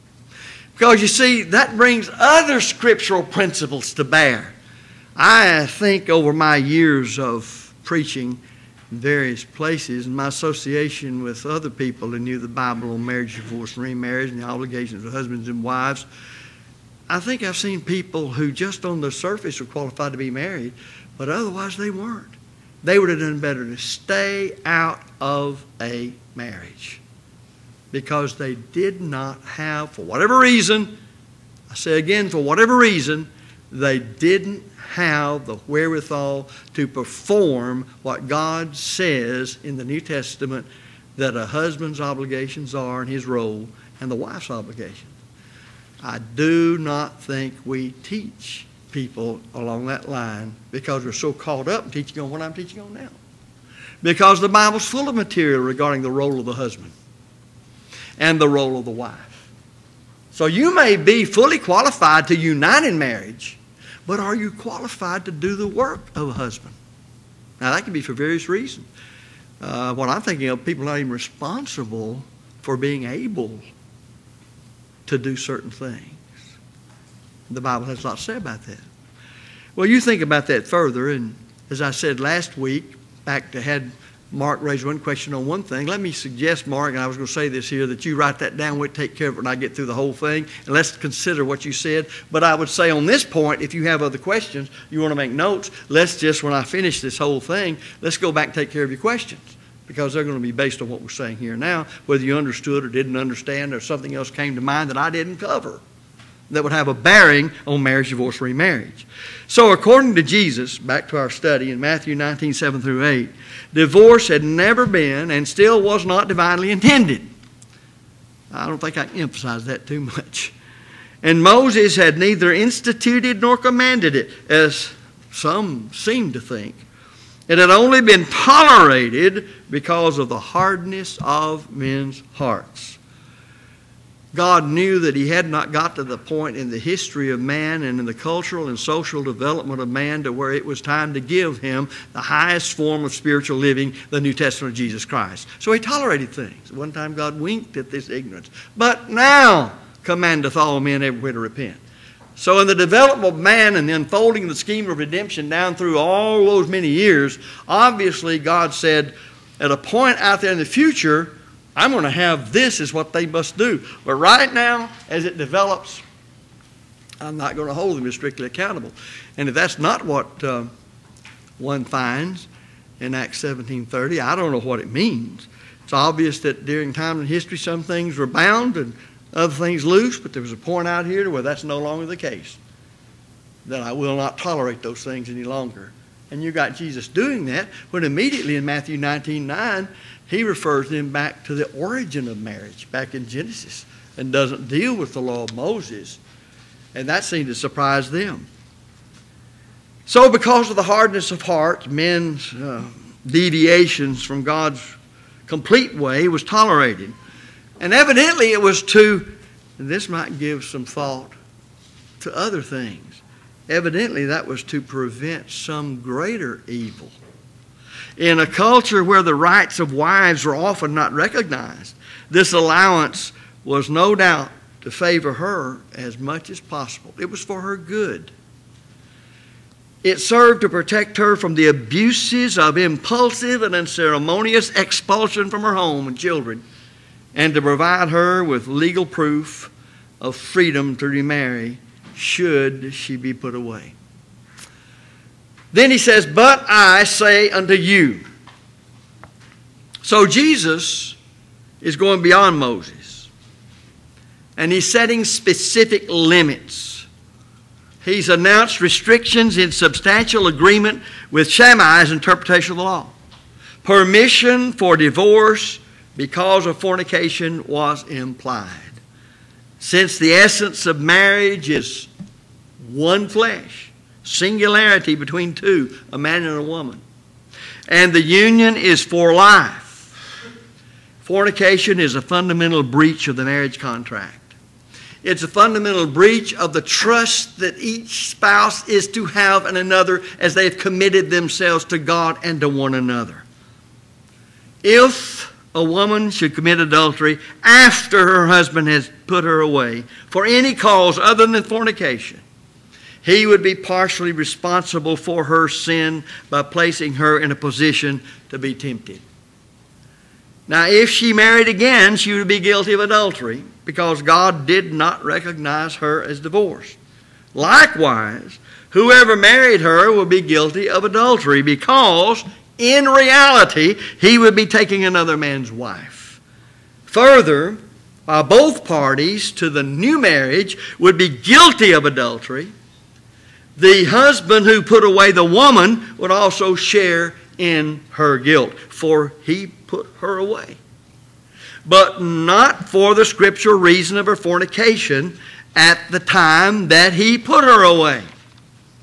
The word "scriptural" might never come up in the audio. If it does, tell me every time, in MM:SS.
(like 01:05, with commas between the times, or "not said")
00:02, 05:43.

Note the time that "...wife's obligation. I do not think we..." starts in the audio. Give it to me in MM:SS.
00:44.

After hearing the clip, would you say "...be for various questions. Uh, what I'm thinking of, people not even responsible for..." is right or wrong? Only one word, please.
wrong.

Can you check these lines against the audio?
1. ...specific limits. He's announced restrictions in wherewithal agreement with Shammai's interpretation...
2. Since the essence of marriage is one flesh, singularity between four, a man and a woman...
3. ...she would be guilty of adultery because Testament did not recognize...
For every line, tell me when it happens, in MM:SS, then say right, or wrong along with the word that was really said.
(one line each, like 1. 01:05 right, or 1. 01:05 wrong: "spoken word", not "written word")
1. 04:15 wrong: "substantial", not "wherewithal"
2. 04:29 wrong: "two", not "four"
3. 05:12 wrong: "God", not "Testament".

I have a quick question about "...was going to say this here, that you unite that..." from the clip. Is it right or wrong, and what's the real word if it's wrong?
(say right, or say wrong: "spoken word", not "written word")
wrong: "write", not "unite".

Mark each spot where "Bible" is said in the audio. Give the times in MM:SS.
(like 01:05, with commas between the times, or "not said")
00:12, 00:54, 01:17.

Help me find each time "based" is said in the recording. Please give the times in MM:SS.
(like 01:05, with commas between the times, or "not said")
01:40.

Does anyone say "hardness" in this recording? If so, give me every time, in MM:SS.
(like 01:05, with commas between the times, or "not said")
02:10, 03:20.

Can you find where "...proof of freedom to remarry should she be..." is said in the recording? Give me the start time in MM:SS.
03:59.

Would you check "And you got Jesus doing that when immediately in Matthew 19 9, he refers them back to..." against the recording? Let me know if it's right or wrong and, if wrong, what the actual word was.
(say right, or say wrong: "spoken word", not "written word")
right.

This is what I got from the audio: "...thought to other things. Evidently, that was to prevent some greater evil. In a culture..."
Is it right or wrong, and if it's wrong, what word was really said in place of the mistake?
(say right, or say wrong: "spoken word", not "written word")
right.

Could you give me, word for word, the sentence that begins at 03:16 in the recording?
And that seemed to surprise them.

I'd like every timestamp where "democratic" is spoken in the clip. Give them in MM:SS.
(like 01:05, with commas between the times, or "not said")
not said.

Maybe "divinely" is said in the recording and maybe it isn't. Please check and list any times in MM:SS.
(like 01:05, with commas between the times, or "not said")
01:56.